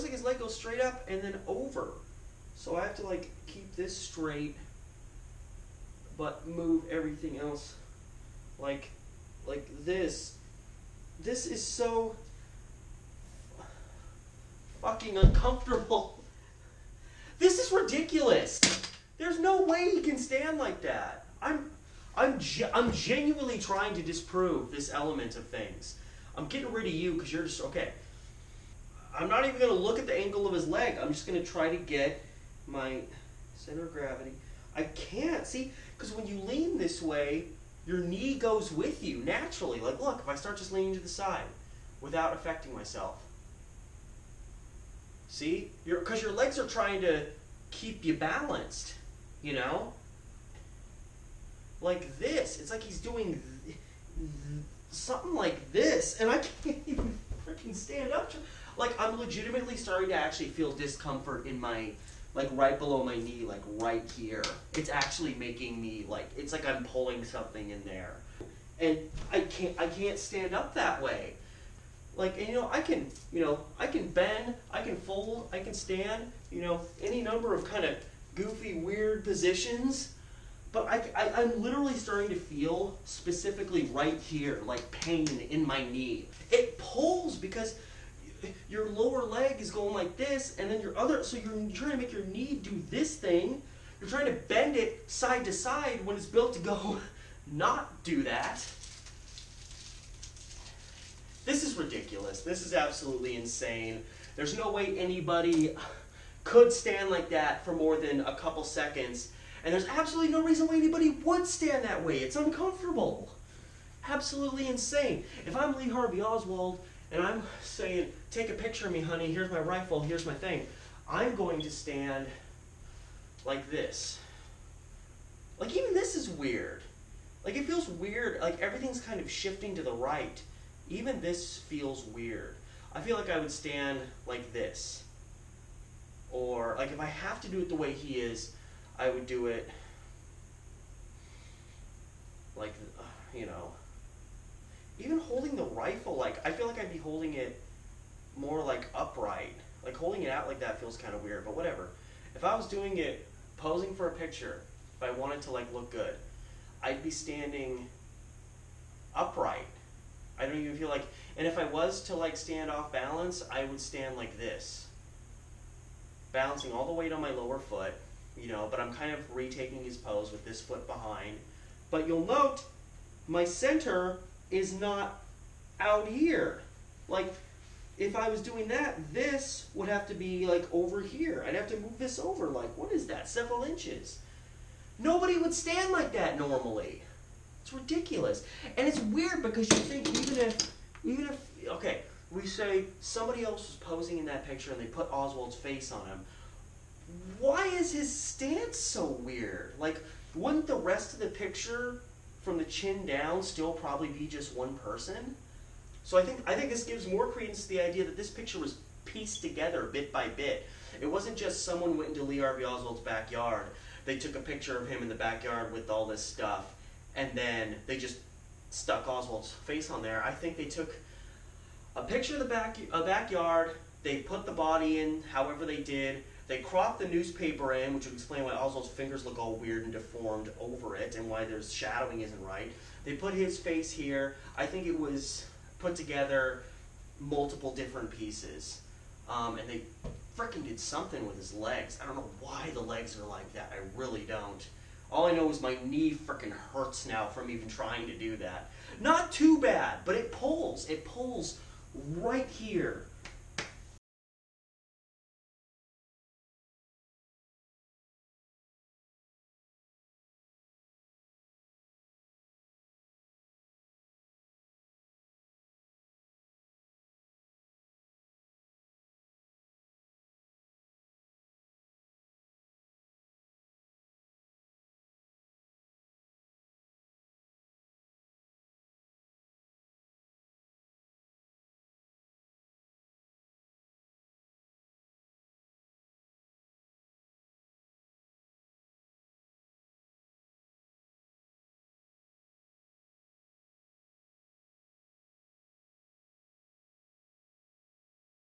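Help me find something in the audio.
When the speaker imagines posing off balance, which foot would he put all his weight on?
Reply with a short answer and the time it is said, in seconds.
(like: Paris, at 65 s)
lower foot, at 167 s.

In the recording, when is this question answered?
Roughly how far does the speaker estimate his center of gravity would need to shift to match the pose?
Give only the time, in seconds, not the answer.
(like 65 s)
183 s.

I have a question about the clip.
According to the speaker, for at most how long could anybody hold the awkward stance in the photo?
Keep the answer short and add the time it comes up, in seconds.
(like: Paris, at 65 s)
a couple seconds, at 108 s.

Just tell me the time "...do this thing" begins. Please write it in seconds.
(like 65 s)
92 s.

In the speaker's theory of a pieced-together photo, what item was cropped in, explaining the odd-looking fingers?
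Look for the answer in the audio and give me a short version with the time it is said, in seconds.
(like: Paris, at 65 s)
newspaper, at 227 s.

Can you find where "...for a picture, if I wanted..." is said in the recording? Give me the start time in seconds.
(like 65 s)
153 s.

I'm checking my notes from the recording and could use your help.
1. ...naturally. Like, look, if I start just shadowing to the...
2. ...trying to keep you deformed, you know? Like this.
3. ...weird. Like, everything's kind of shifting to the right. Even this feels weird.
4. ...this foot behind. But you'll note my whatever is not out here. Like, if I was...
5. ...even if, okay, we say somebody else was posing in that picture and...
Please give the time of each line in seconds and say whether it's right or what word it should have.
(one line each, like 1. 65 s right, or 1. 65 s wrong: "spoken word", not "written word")
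1. 39 s wrong: "leaning", not "shadowing"
2. 46 s wrong: "balanced", not "deformed"
3. 127 s right
4. 170 s wrong: "center", not "whatever"
5. 191 s right.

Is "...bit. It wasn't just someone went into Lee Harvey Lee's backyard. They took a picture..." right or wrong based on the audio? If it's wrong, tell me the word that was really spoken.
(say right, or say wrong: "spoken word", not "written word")
wrong: "Oswald", not "Lee".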